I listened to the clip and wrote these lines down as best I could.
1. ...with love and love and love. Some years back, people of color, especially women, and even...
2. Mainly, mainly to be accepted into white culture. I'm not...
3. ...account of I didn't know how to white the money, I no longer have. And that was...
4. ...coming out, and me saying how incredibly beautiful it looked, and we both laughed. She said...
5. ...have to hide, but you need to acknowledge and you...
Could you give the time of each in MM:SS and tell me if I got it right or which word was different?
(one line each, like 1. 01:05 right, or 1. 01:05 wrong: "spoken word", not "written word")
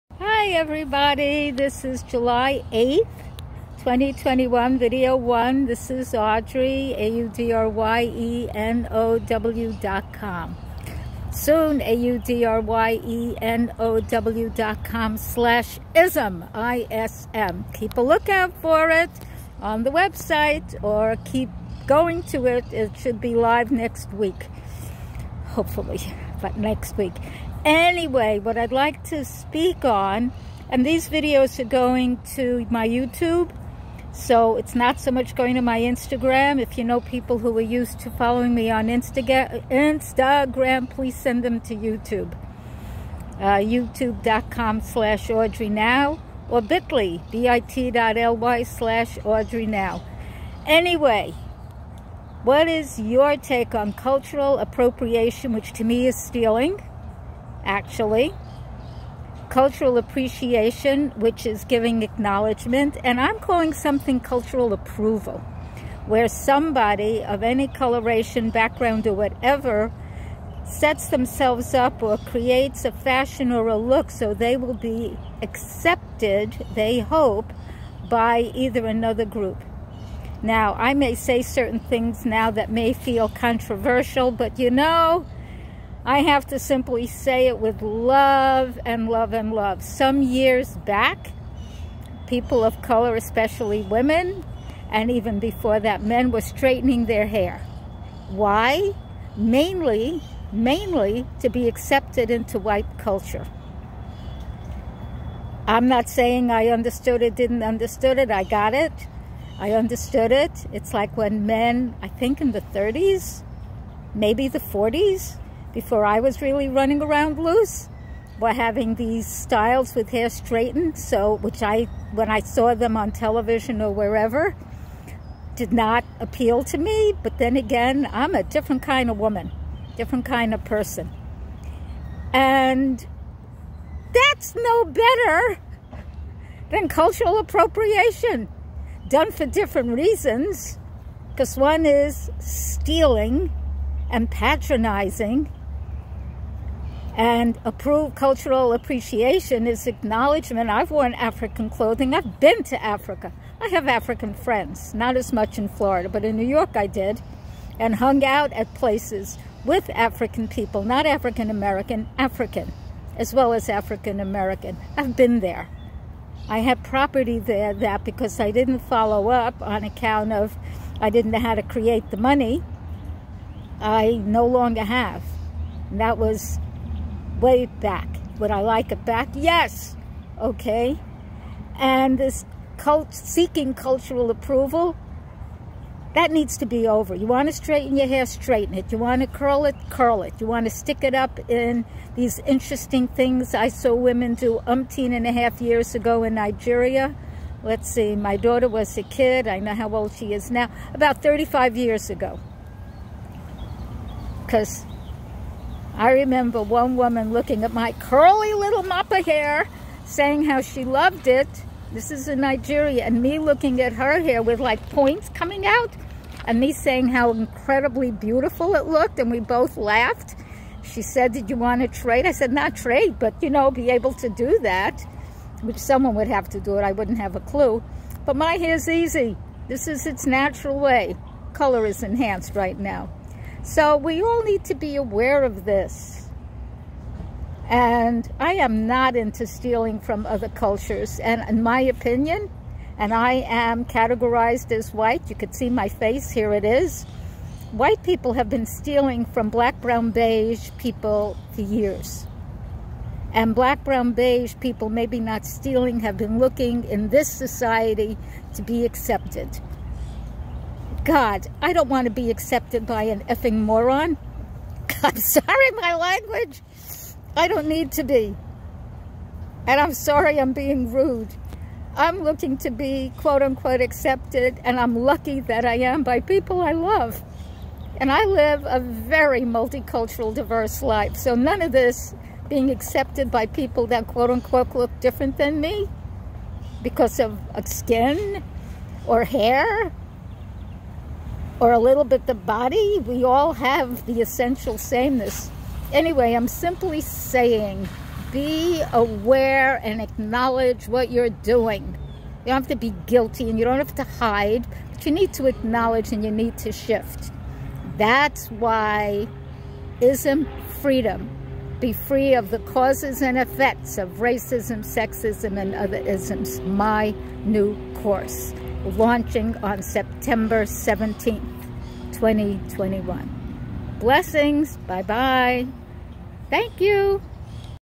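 1. 01:27 right
2. 01:39 right
3. 02:49 wrong: "create", not "white"
4. 03:35 right
5. 05:03 right.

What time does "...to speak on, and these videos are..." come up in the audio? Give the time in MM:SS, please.
00:29.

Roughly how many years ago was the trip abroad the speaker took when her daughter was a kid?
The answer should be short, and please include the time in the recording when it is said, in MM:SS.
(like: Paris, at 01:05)
35 years, at 03:20.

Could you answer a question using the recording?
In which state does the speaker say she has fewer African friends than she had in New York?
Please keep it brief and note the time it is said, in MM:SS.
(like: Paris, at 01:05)
Florida, at 02:35.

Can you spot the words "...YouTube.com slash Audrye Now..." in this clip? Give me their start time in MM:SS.
00:43.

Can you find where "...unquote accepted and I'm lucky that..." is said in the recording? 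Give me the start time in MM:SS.
04:33.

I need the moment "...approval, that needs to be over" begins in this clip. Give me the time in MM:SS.
03:04.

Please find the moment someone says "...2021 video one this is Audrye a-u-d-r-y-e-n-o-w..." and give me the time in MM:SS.
00:03.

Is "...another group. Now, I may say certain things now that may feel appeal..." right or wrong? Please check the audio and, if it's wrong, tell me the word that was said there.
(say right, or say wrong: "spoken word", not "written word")
wrong: "controversial", not "appeal".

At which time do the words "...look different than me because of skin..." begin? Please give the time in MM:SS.
04:44.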